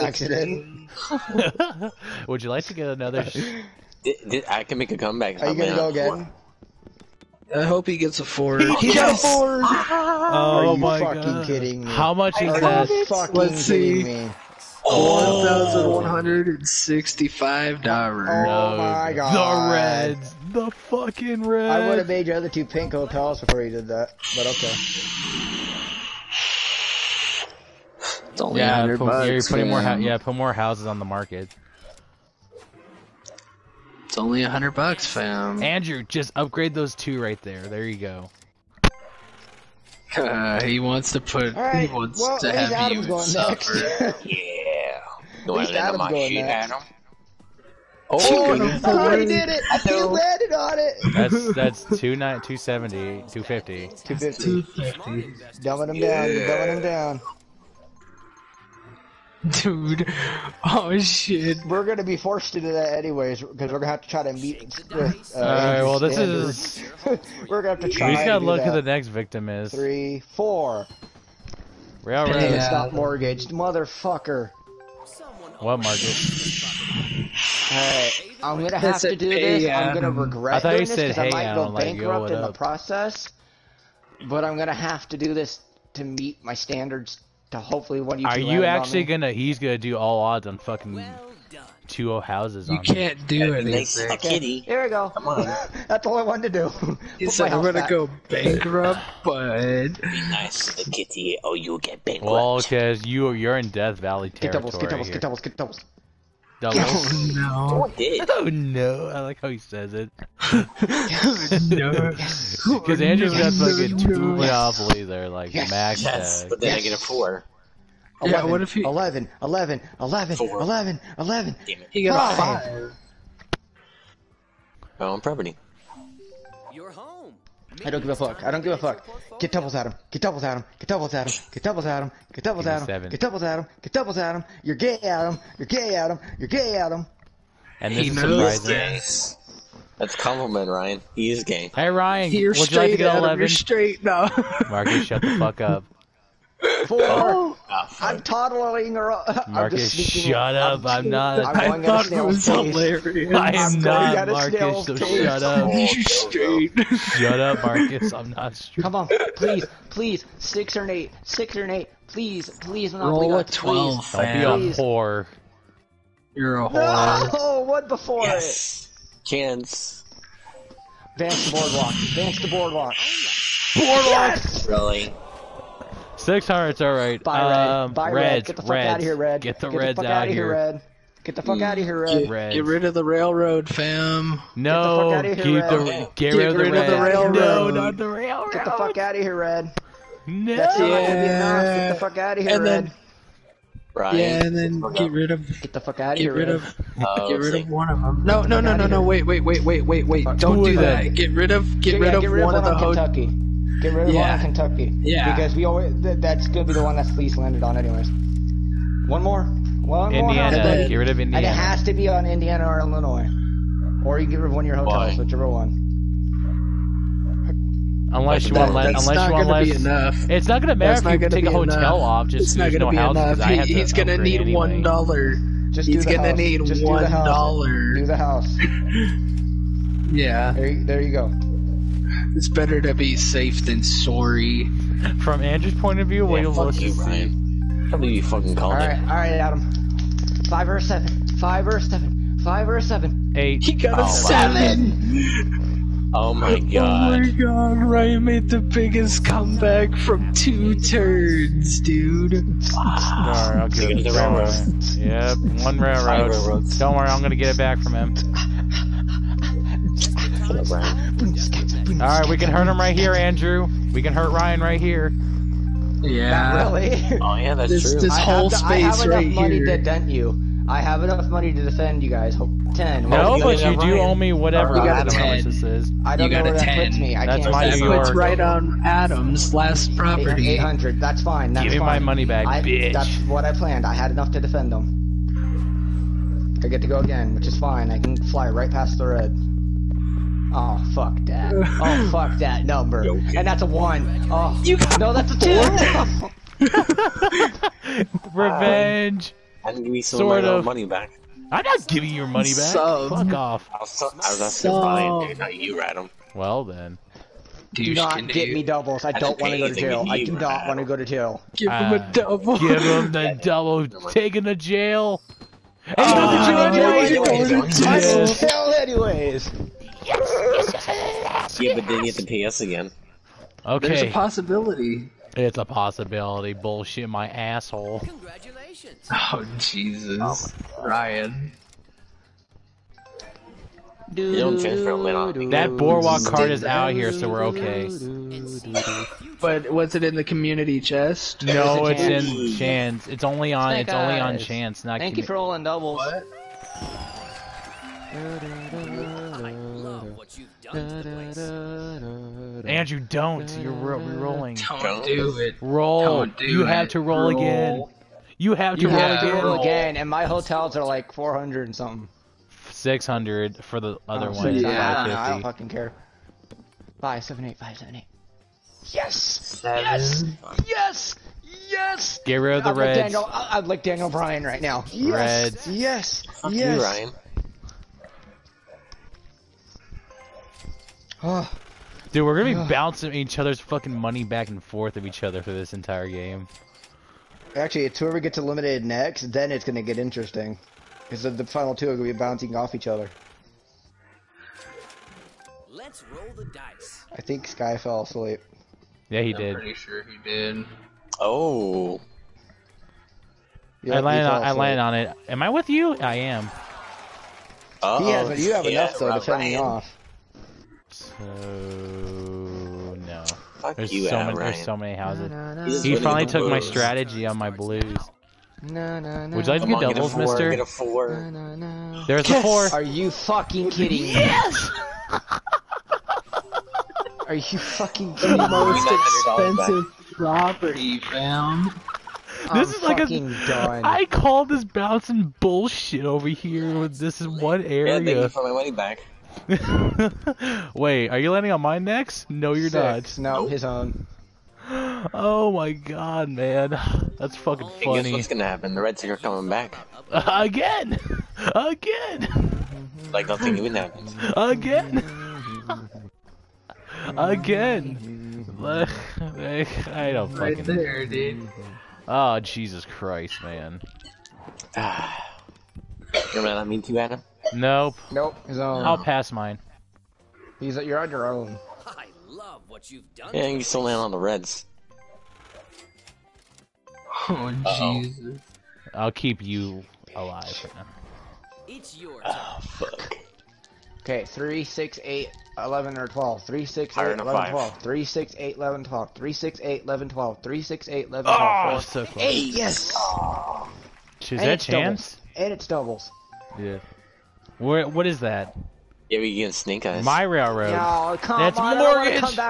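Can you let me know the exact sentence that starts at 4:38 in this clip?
puts right on Adam's last property.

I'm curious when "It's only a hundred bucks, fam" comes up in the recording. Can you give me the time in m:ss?
0:34.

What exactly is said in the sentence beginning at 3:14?
Yeah, and then get rid of get the fuck out of here.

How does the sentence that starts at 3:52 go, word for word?
It's better to be safe than sorry.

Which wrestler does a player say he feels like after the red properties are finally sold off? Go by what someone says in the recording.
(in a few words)
Daniel Bryan.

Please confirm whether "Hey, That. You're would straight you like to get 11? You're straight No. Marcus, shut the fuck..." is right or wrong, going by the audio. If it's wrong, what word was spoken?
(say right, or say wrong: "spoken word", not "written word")
wrong: "Ryan", not "That".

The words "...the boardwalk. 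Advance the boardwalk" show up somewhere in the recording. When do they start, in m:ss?
2:51.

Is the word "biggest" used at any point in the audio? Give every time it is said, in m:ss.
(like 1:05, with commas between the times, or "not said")
4:08.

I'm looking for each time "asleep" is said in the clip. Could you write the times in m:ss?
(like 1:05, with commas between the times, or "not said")
6:38.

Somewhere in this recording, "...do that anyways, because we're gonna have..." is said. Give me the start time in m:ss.
1:02.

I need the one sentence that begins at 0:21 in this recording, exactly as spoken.
I would have made your other two pink hotels before you did that, but okay.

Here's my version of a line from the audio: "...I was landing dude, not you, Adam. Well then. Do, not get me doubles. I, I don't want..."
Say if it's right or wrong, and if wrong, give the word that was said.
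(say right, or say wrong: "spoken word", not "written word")
wrong: "asking", not "landing".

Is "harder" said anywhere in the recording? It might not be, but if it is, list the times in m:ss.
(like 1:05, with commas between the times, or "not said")
not said.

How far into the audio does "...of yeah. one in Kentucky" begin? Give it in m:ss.
3:24.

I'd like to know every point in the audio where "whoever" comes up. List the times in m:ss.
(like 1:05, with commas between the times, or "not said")
6:27.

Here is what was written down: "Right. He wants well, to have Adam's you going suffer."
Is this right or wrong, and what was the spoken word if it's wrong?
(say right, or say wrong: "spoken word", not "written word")
right.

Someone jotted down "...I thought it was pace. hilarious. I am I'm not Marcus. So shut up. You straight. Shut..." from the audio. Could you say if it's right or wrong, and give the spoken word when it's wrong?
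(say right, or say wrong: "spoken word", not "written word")
right.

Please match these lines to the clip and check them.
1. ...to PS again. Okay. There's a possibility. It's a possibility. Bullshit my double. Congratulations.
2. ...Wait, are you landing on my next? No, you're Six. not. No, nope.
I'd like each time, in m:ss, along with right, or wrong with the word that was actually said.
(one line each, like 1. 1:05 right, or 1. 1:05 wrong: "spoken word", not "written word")
1. 5:22 wrong: "asshole", not "double"
2. 7:20 right.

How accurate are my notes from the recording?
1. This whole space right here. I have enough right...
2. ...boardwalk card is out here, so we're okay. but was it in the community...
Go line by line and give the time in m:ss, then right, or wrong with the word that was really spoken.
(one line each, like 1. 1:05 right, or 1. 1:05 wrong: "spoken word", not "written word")
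1. 4:28 right
2. 5:35 right.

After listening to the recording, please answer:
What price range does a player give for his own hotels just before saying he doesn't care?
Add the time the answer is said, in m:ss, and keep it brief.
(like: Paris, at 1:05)
400 and something, at 6:01.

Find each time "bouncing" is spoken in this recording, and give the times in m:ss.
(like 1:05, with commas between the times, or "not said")
6:22, 6:32, 7:14.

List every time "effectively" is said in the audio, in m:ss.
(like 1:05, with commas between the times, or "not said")
not said.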